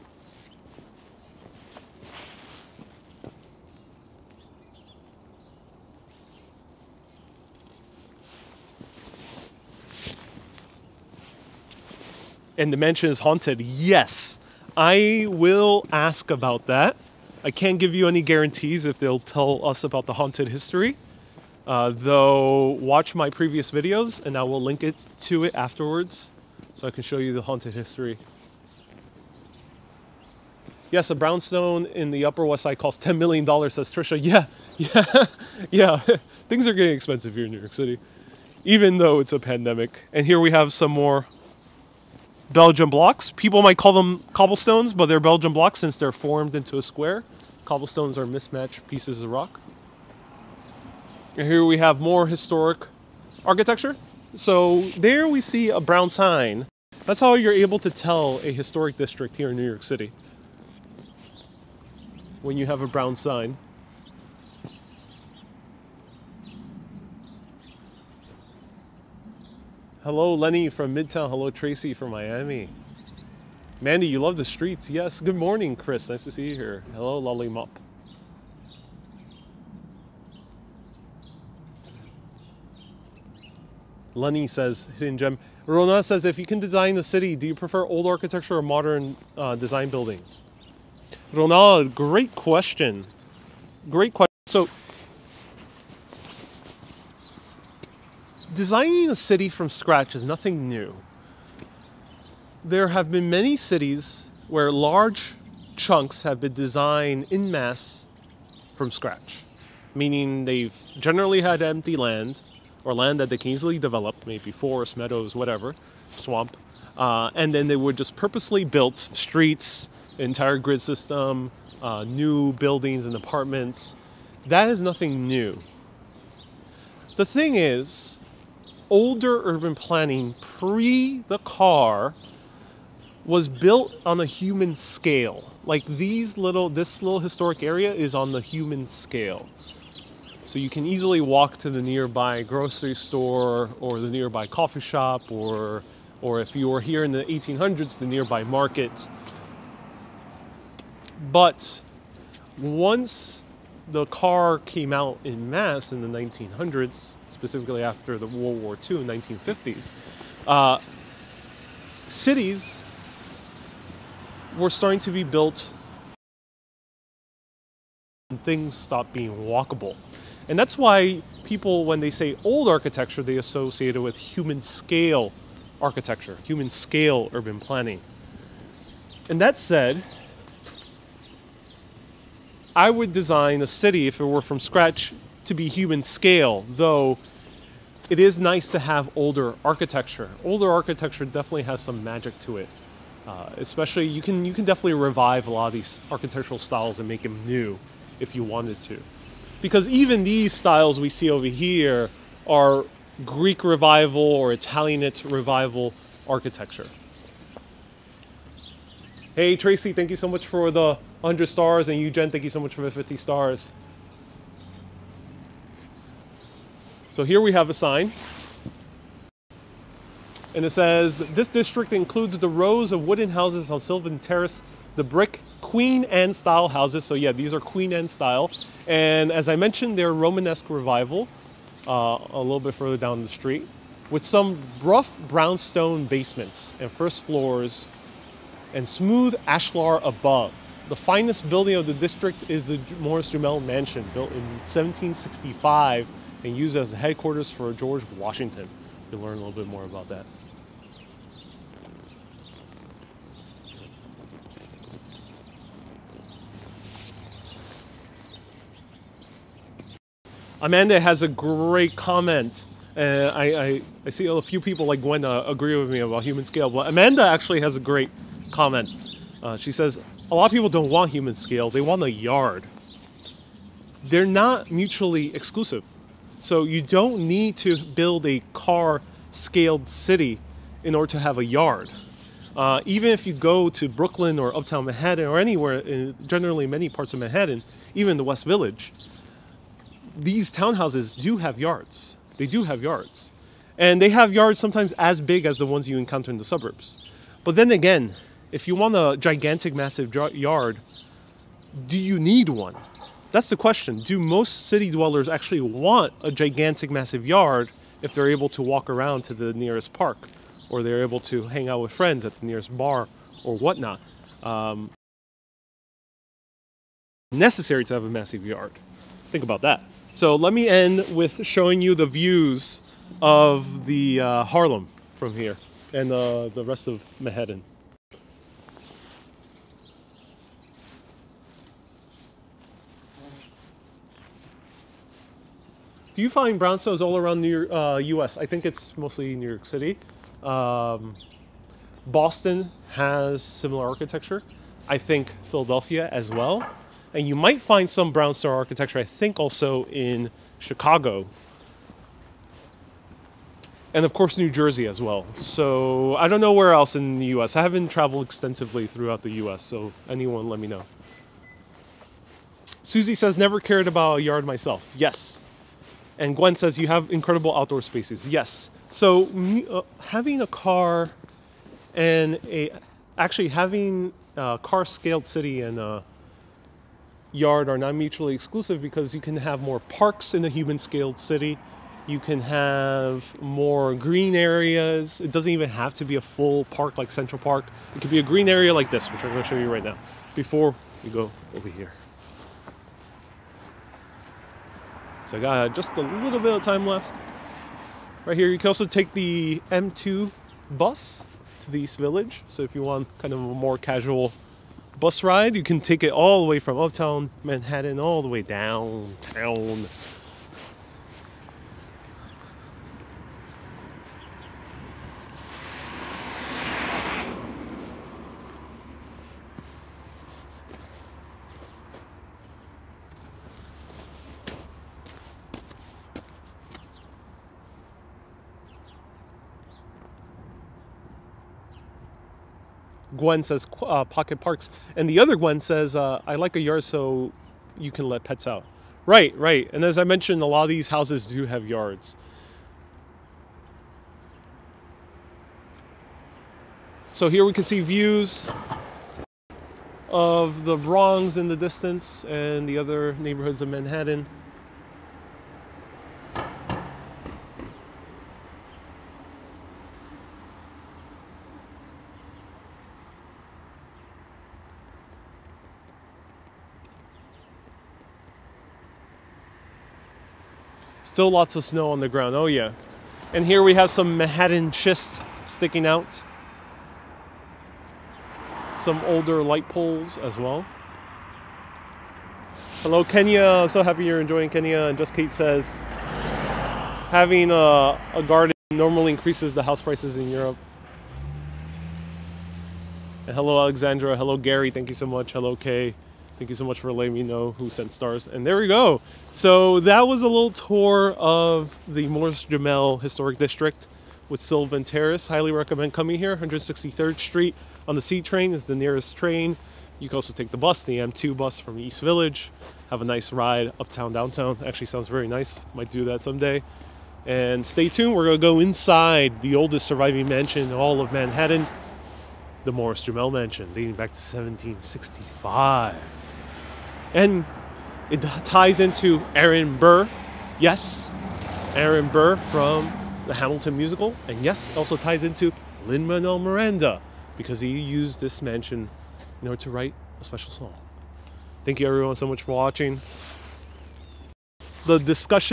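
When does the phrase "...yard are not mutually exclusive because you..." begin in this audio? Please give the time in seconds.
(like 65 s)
377 s.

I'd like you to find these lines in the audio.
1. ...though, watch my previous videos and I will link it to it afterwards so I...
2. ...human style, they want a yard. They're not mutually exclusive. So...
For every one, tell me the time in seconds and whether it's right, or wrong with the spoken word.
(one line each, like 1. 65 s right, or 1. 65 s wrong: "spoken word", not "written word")
1. 21 s right
2. 271 s wrong: "scale", not "style".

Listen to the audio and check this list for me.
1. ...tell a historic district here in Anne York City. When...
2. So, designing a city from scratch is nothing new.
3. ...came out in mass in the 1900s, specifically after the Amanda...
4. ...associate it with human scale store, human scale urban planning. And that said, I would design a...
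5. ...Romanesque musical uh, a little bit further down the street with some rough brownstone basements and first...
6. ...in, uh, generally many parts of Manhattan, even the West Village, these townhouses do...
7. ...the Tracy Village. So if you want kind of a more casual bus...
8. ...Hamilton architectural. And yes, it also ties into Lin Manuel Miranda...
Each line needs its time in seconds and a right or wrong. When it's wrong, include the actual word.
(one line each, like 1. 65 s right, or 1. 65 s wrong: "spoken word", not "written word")
1. 57 s wrong: "New", not "Anne"
2. 94 s right
3. 154 s wrong: "World", not "Amanda"
4. 173 s wrong: "architecture", not "store"
5. 230 s wrong: "revival", not "musical"
6. 285 s right
7. 401 s wrong: "East", not "Tracy"
8. 533 s wrong: "musical", not "architectural".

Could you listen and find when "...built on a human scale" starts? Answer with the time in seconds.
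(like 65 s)
133 s.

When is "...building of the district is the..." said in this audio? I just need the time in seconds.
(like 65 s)
241 s.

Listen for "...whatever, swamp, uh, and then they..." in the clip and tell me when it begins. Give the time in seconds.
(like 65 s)
115 s.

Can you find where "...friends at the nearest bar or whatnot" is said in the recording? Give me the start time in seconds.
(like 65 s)
311 s.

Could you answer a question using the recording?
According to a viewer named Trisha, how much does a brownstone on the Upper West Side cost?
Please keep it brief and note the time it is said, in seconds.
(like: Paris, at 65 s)
$10 million, at 33 s.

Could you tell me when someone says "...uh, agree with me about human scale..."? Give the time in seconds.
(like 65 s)
265 s.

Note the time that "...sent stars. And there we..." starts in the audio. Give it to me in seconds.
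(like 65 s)
497 s.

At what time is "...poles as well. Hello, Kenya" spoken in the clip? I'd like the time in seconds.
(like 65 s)
479 s.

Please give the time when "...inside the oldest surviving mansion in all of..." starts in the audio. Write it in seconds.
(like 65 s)
518 s.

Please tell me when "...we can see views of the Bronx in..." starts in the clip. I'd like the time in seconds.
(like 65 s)
447 s.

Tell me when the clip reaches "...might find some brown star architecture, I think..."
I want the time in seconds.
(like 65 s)
347 s.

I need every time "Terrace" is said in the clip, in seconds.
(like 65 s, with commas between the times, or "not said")
224 s, 504 s.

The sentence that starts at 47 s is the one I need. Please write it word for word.
Cobblestones are mismatched pieces of rock.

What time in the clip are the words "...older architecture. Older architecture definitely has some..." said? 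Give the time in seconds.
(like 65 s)
189 s.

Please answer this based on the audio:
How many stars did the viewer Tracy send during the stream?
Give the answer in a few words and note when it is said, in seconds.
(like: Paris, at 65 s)
100, at 211 s.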